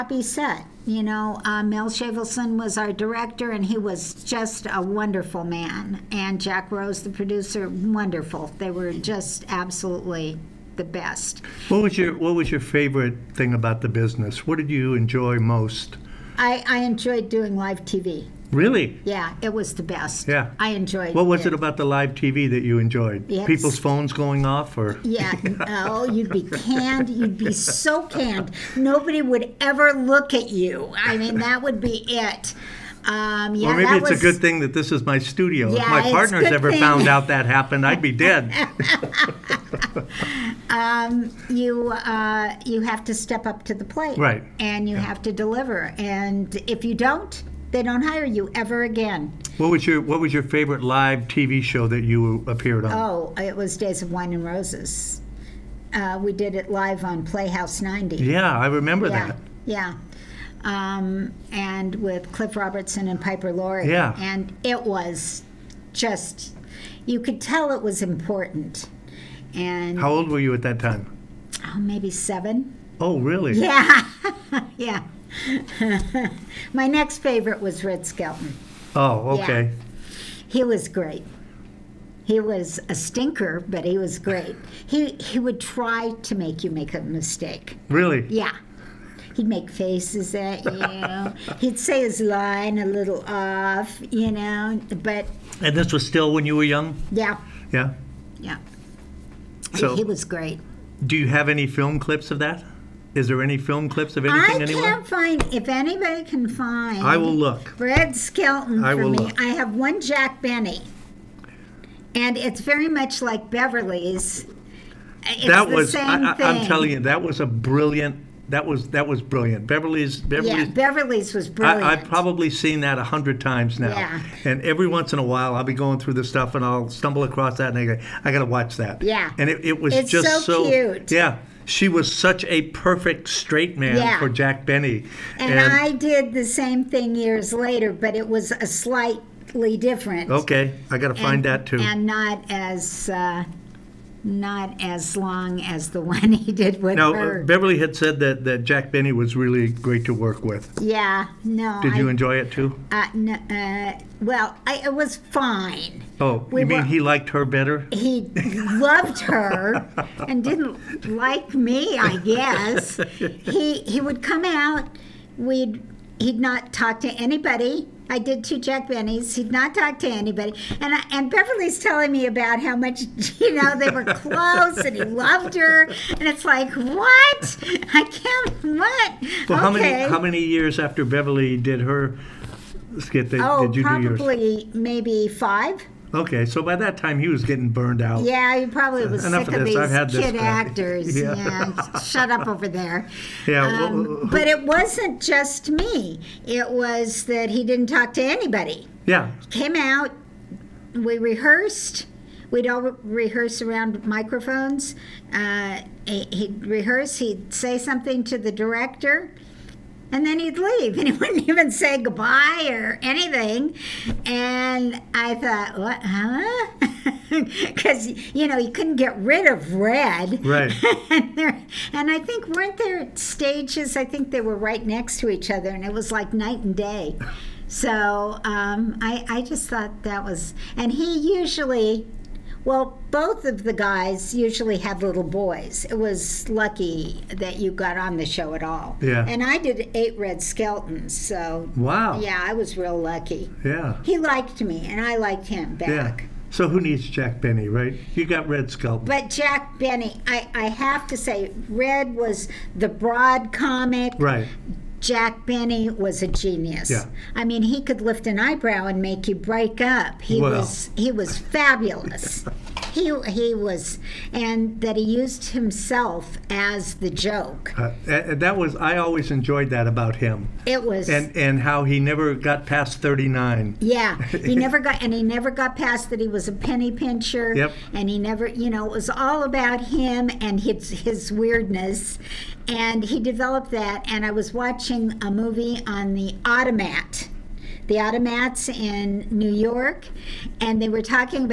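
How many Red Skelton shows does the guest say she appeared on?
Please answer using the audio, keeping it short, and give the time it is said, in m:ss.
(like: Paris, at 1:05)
8, at 3:59.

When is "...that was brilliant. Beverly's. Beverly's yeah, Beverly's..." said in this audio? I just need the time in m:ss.
1:58.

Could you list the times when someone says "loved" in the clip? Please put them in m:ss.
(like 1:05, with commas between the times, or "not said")
2:38, 2:55.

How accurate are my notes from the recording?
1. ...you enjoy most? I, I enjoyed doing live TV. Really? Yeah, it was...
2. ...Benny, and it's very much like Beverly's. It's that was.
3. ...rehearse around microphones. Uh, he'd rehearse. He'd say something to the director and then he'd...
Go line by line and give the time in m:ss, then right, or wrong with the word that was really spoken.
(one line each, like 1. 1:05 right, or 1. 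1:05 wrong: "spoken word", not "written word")
1. 0:14 right
2. 1:50 right
3. 3:22 right.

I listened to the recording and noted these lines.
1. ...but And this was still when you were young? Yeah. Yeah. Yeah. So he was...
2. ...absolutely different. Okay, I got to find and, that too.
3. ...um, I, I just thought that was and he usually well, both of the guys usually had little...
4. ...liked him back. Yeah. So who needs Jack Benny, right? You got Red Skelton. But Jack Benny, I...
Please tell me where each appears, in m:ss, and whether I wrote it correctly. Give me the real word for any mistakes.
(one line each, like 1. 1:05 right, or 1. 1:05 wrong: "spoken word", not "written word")
1. 1:35 right
2. 2:18 wrong: "slightly", not "absolutely"
3. 3:48 right
4. 4:05 right.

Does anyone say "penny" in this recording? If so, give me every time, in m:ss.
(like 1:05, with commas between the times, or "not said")
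4:36.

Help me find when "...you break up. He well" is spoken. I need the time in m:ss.
4:19.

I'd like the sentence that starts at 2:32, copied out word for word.
Uh, no, uh, well, I, it was fine.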